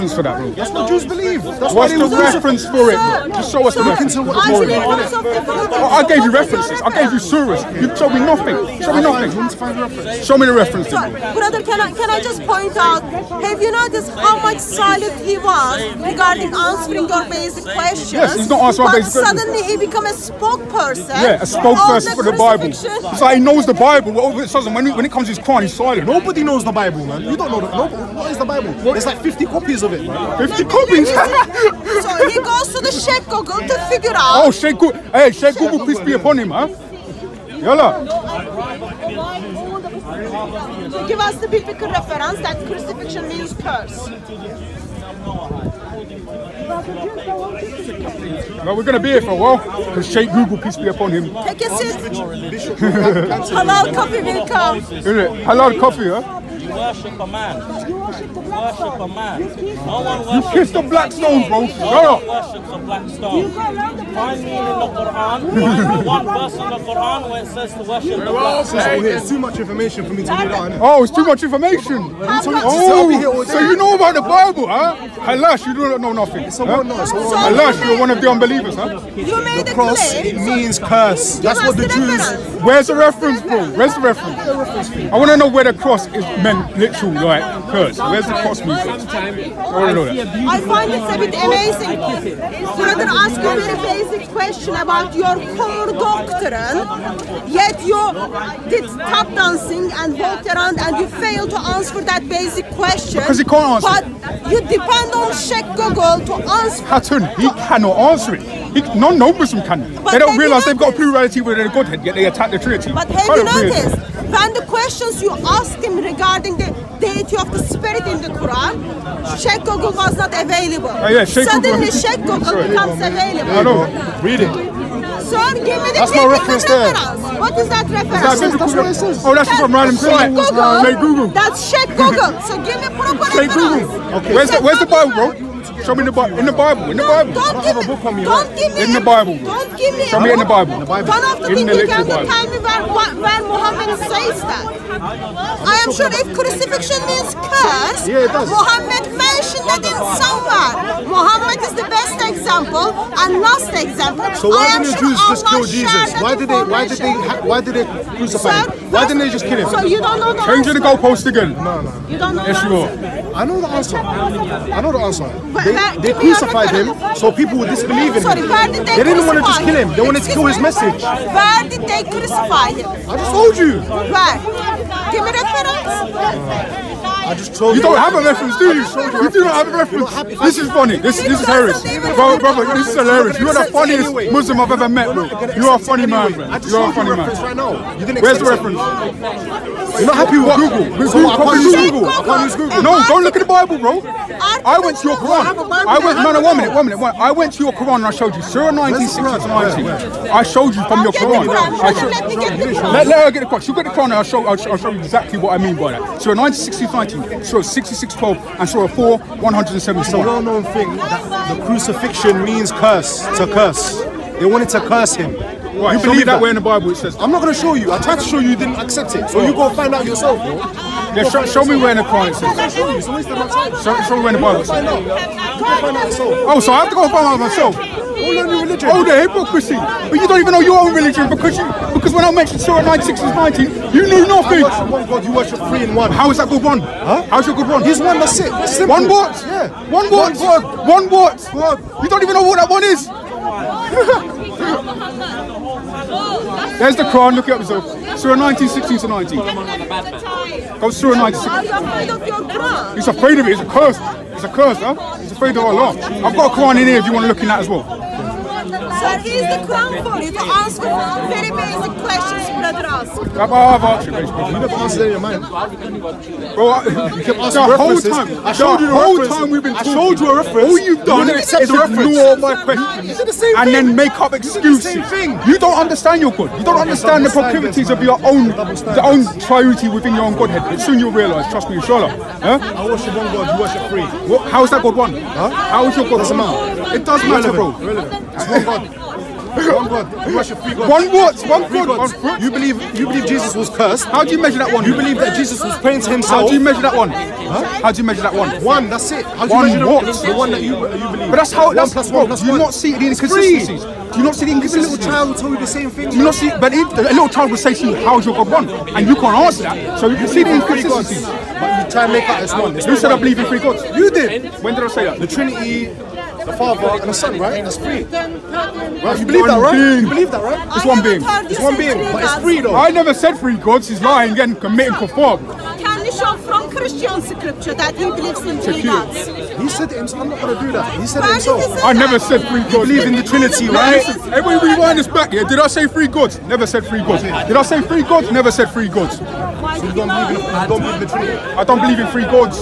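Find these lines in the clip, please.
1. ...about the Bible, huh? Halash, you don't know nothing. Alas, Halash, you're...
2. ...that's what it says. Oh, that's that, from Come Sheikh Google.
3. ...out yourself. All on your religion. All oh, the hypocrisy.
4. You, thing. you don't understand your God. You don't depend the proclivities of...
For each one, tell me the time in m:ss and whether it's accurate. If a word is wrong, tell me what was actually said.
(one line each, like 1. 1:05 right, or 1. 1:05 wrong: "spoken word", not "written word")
1. 1:13 right
2. 2:08 wrong: "Random", not "Come"
3. 3:47 wrong: "myself", not "yourself"
4. 4:34 wrong: "understand", not "depend".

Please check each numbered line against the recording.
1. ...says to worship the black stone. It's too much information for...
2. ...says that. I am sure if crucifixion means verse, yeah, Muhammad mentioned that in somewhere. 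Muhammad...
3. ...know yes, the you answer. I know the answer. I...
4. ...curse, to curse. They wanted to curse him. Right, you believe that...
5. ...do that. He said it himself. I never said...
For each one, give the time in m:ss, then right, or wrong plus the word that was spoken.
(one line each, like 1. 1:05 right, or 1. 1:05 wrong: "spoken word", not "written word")
1. 1:07 right
2. 2:23 wrong: "curse", not "verse"
3. 2:42 right
4. 3:32 right
5. 5:30 right.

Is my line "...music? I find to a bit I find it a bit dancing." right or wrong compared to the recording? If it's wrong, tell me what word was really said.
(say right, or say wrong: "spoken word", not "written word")
wrong: "amazing", not "dancing".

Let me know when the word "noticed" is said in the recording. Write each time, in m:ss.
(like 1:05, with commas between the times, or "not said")
0:13, 1:53.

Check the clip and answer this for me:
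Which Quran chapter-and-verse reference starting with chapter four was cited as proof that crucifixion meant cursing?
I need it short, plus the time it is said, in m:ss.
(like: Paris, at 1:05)
4:177, at 3:28.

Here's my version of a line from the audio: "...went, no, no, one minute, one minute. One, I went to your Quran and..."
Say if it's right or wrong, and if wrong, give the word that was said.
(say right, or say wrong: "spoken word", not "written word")
right.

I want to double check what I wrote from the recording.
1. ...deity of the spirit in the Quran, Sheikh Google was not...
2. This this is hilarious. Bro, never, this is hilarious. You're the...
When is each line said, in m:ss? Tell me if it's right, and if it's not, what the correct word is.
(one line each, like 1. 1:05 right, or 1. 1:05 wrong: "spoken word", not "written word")
1. 1:56 right
2. 3:00 wrong: "brother", not "never".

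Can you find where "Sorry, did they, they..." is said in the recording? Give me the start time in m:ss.
2:48.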